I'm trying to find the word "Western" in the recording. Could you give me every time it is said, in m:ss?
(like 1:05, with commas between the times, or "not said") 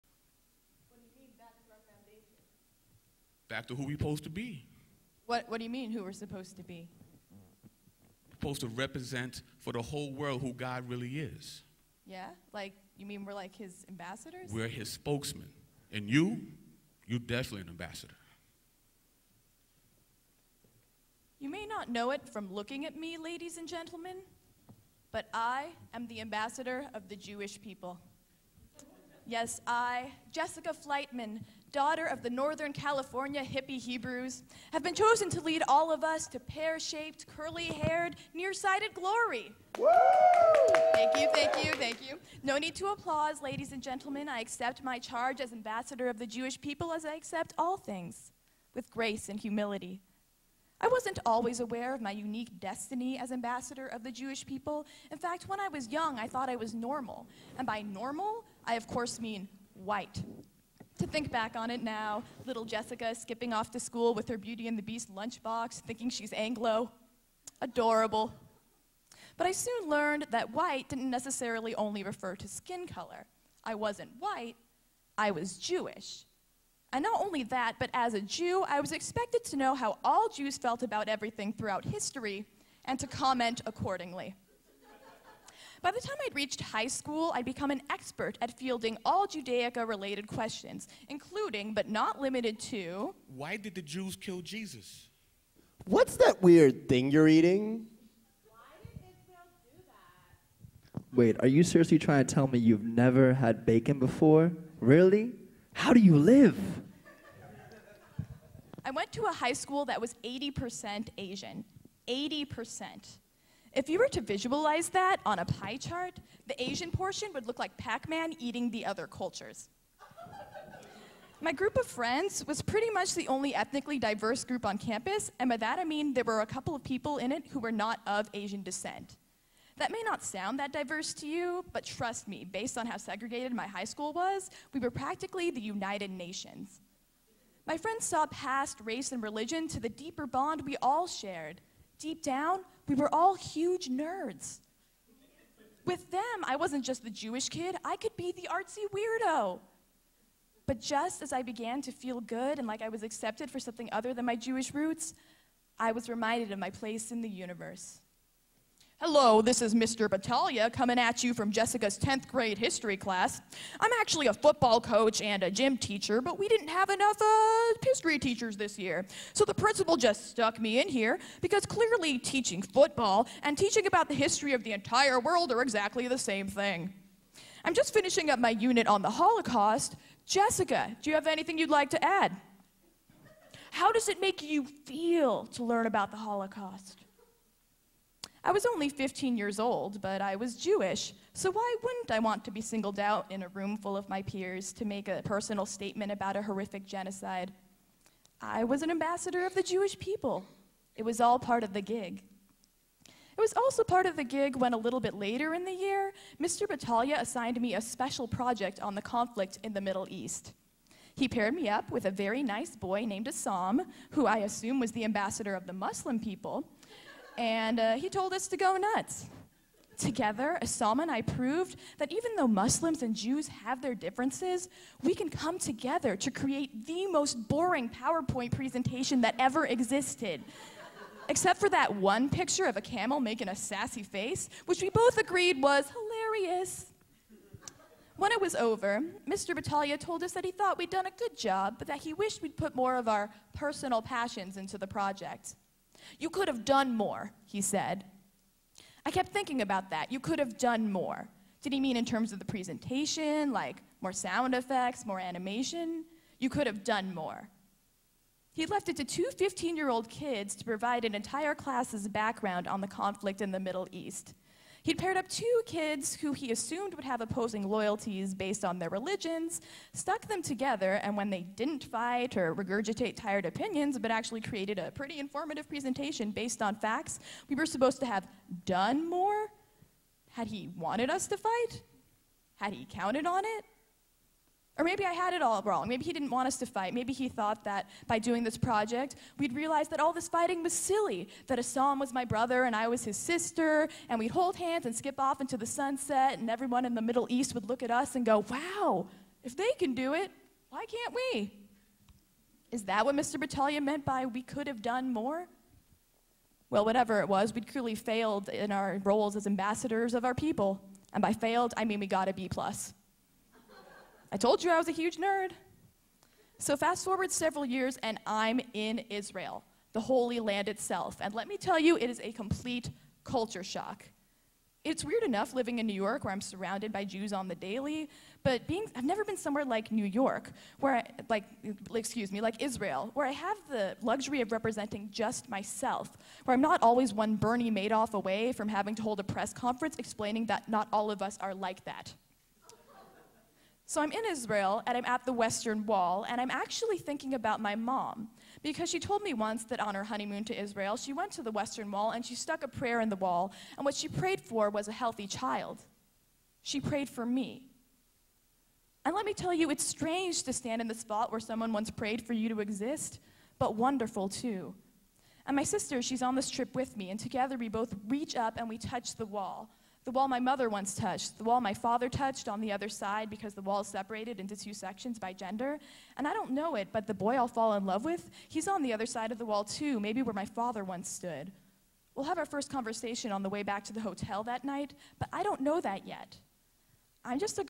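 5:45, 5:51.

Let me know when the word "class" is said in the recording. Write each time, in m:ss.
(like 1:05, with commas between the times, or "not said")
2:42, 4:21.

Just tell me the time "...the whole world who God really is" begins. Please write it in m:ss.
0:09.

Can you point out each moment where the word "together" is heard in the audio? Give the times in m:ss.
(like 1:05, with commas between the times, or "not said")
3:39, 3:45, 4:30, 6:07.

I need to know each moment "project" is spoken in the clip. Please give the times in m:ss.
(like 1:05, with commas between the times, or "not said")
3:28, 4:04, 4:48.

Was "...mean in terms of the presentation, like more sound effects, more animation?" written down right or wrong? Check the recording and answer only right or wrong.
right.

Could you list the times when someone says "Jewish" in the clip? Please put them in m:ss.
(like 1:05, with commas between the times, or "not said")
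0:27, 0:46, 0:54, 1:15, 2:27, 2:34, 3:10, 3:19.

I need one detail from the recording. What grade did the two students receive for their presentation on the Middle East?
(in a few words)
B plus.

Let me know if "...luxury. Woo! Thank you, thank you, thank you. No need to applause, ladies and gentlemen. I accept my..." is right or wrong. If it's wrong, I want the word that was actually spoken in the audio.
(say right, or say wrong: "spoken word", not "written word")
wrong: "glory", not "luxury".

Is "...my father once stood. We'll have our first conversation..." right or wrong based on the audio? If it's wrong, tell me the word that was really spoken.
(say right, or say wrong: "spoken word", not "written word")
right.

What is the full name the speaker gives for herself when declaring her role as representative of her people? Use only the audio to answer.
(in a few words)
Jessica Fleitman.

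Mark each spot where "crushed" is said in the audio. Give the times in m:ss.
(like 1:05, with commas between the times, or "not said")
not said.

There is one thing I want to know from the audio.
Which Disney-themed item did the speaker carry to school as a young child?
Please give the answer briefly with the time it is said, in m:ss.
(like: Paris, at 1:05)
Beauty and the Beast lunchbox, at 1:04.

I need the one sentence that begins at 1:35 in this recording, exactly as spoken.
What's that weird thing you're eating?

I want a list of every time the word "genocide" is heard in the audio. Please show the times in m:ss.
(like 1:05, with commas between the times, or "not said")
3:16.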